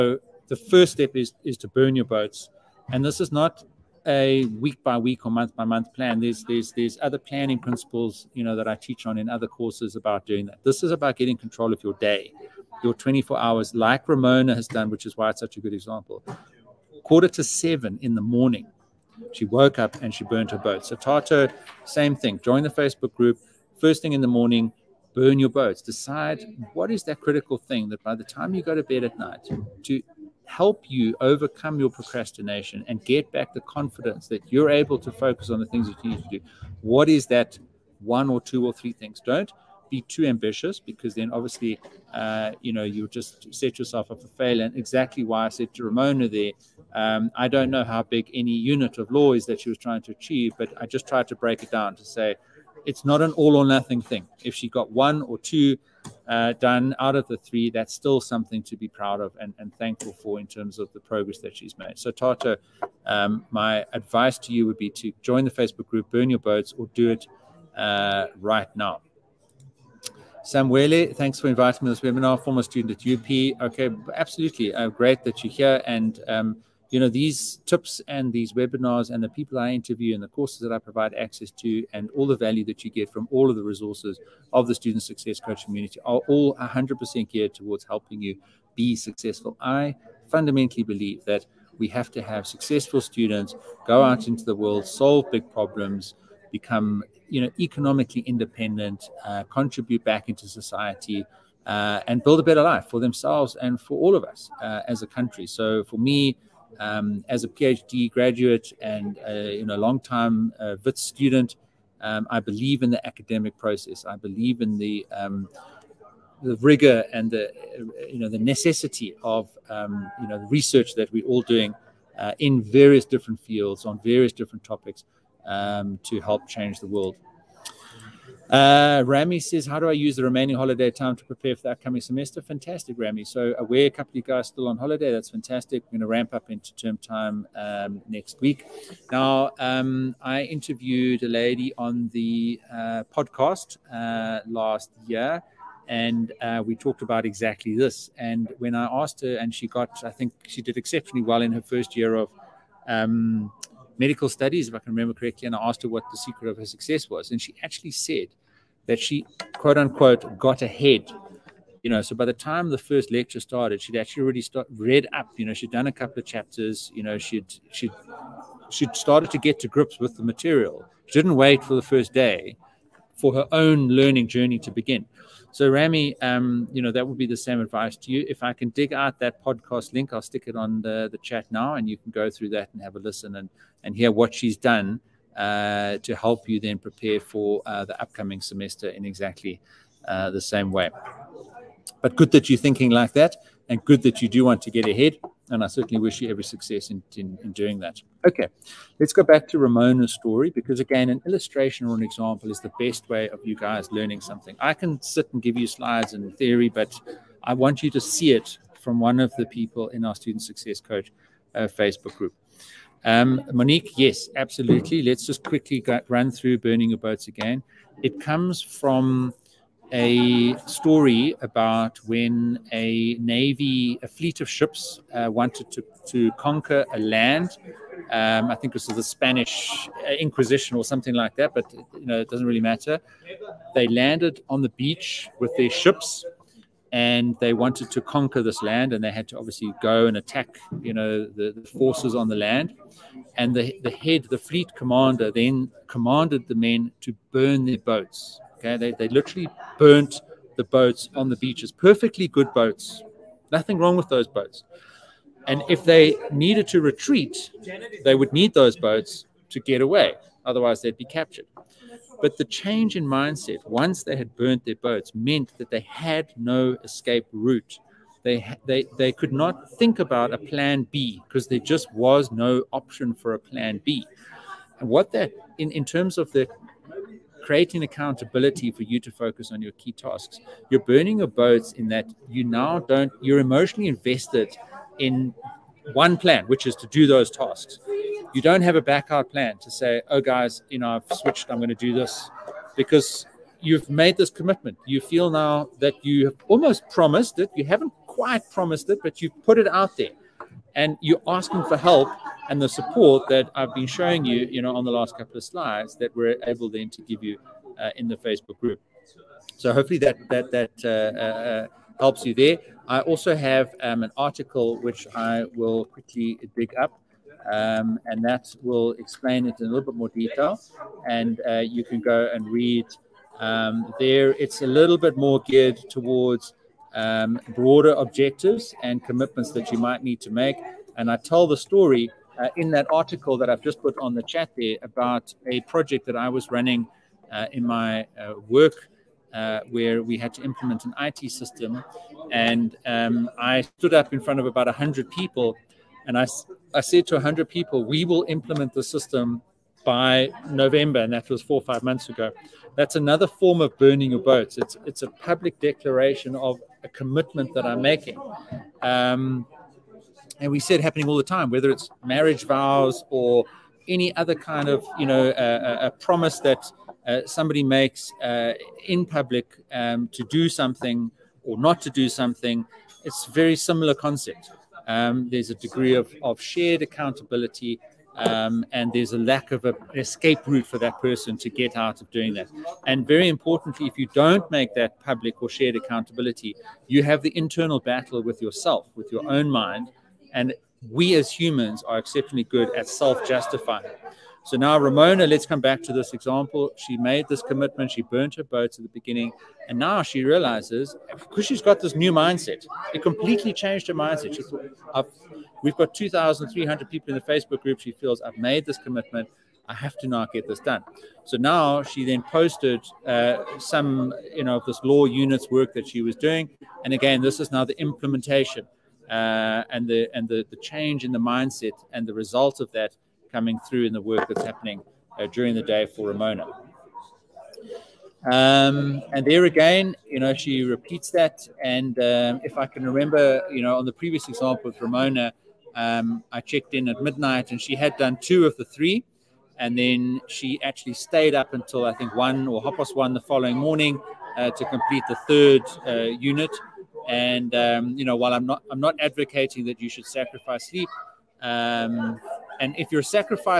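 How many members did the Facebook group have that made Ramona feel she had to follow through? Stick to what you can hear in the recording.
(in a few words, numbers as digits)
2,300.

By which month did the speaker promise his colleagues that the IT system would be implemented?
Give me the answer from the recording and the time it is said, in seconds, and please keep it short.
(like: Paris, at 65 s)
November, at 350 s.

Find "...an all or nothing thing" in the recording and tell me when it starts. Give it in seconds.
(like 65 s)
53 s.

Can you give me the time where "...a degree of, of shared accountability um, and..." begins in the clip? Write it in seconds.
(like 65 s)
375 s.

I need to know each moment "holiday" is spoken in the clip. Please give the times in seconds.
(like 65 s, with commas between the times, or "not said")
130 s, 134 s.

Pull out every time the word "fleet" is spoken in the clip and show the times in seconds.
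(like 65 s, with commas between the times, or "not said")
224 s, 244 s.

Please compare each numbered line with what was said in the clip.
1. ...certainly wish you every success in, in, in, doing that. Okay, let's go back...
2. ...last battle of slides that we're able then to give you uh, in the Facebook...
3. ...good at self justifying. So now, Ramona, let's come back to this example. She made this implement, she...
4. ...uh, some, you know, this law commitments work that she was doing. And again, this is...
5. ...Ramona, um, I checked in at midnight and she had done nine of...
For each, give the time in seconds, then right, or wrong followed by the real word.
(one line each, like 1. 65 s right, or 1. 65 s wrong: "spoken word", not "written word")
1. 195 s right
2. 304 s wrong: "couple", not "battle"
3. 392 s wrong: "commitment", not "implement"
4. 413 s wrong: "units", not "commitments"
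5. 434 s wrong: "two", not "nine".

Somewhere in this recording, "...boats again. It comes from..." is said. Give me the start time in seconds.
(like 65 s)
216 s.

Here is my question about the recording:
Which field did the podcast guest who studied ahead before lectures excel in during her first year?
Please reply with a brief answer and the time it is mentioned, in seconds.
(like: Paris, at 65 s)
medical studies, at 154 s.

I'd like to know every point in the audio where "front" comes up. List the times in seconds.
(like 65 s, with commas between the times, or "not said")
344 s.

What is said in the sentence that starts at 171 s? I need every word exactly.
She didn't wait for the first day for her own learning journey to begin.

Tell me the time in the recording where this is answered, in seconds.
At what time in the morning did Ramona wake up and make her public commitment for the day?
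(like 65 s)
17 s.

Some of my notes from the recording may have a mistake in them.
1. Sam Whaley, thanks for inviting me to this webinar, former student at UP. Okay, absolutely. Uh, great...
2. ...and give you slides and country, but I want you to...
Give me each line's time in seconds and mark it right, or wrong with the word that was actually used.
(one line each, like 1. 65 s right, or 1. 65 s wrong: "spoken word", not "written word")
1. 70 s right
2. 205 s wrong: "theory", not "country".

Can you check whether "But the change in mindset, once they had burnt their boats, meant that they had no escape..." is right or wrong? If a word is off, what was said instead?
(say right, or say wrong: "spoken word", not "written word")
right.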